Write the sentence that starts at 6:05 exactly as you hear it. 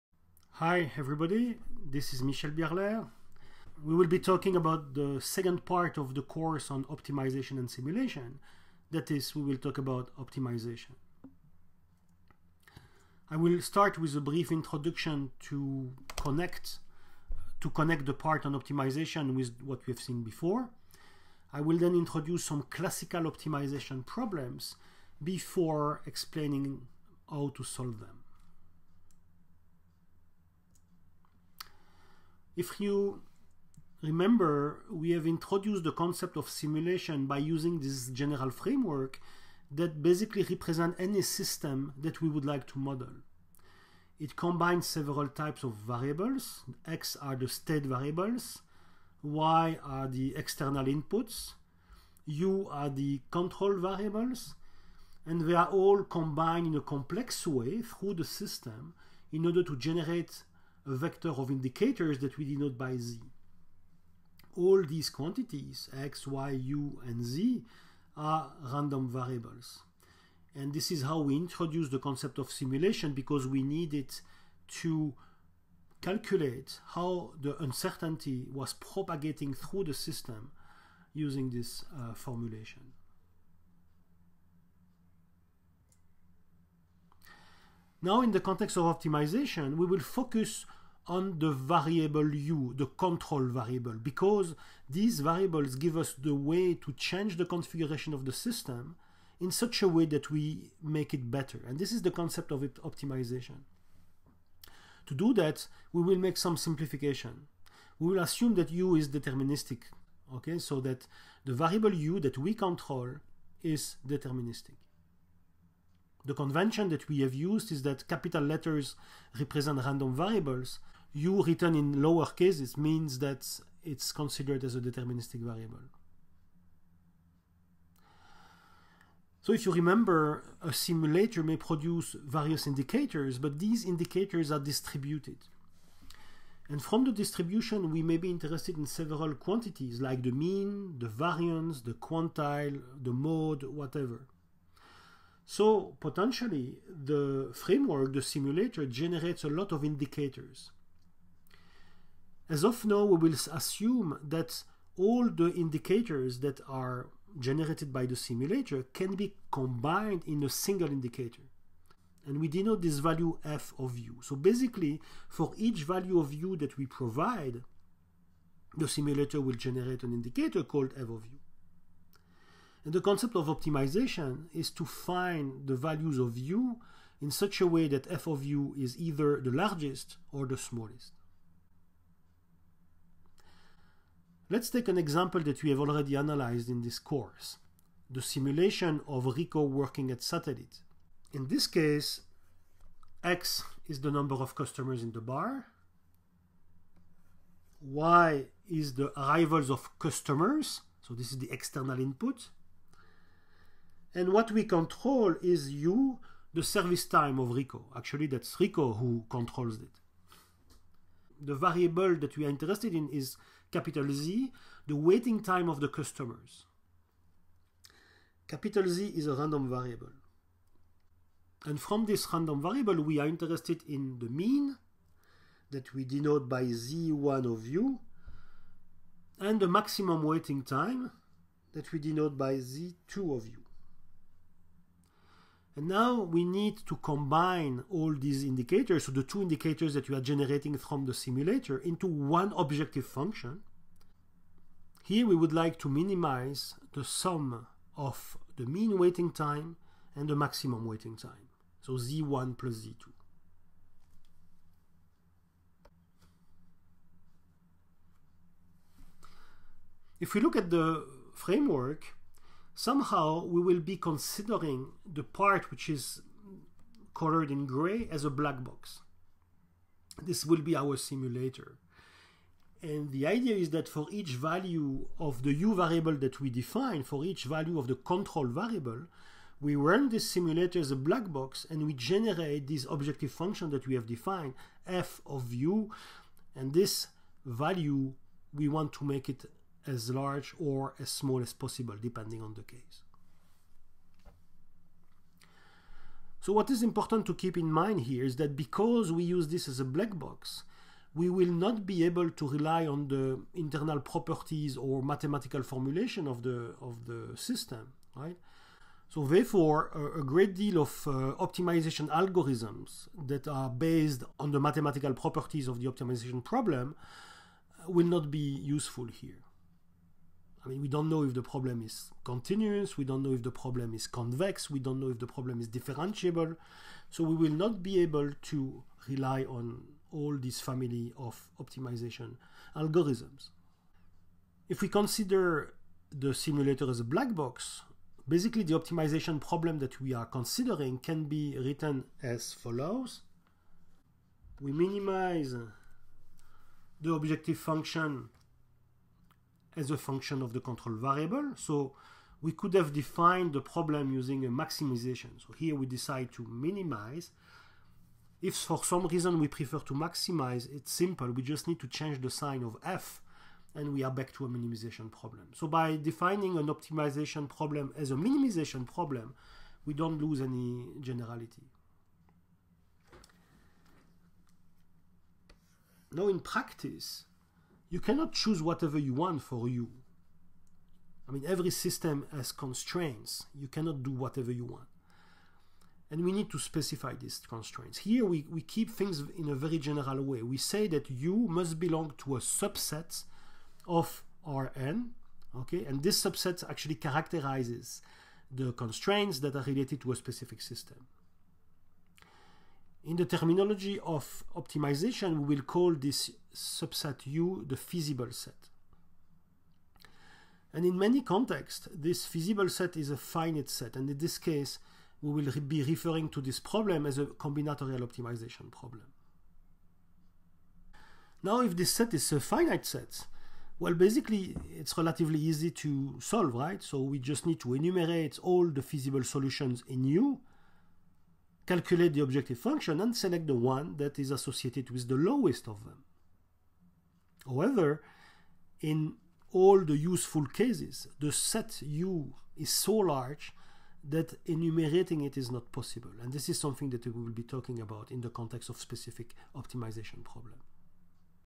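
So by defining an optimization problem as a minimization problem, we don't lose any generality.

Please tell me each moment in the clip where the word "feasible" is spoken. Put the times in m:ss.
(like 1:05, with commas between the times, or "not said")
6:47, 6:52, 7:08.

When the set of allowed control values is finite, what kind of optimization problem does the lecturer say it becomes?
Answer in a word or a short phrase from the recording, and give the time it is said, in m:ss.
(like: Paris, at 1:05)
combinatorial optimization problem, at 6:57.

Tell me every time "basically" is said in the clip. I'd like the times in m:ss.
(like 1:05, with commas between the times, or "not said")
0:40, 2:44, 5:38, 7:03.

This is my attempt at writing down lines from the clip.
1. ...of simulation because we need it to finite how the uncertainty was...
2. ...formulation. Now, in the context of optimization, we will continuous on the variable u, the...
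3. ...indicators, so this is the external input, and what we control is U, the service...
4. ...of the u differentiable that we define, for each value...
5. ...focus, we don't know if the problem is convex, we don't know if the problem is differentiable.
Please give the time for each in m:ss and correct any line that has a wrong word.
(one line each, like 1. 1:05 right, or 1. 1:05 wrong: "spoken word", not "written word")
1. 1:12 wrong: "calculate", not "finite"
2. 1:22 wrong: "focus", not "continuous"
3. 3:19 wrong: "customers", not "indicators"
4. 4:35 wrong: "variable", not "differentiable"
5. 5:22 wrong: "continuous", not "focus".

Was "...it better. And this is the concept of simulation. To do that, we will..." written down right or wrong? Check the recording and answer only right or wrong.
wrong.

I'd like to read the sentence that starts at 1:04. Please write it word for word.
All these quantities, x, y, u, and z, are random variables.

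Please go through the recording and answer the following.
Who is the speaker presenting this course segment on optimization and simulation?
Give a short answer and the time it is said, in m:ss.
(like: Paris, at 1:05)
Michel Bierlaire, at 0:02.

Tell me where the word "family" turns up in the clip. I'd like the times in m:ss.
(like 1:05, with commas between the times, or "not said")
5:30.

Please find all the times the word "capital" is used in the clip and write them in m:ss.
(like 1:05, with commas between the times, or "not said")
1:58, 3:33, 3:38.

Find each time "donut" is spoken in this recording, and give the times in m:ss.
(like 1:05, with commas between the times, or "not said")
not said.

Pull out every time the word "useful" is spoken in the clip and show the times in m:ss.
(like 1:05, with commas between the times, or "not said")
5:18, 7:19.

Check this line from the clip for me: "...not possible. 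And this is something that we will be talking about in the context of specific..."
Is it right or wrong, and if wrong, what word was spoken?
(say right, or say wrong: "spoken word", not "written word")
right.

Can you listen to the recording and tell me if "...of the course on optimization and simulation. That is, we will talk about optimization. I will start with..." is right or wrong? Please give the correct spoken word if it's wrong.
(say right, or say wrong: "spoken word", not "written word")
right.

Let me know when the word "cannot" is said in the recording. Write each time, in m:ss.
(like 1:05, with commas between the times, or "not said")
6:17, 6:23.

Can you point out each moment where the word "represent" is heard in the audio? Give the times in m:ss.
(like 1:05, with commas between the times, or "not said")
0:40, 1:59.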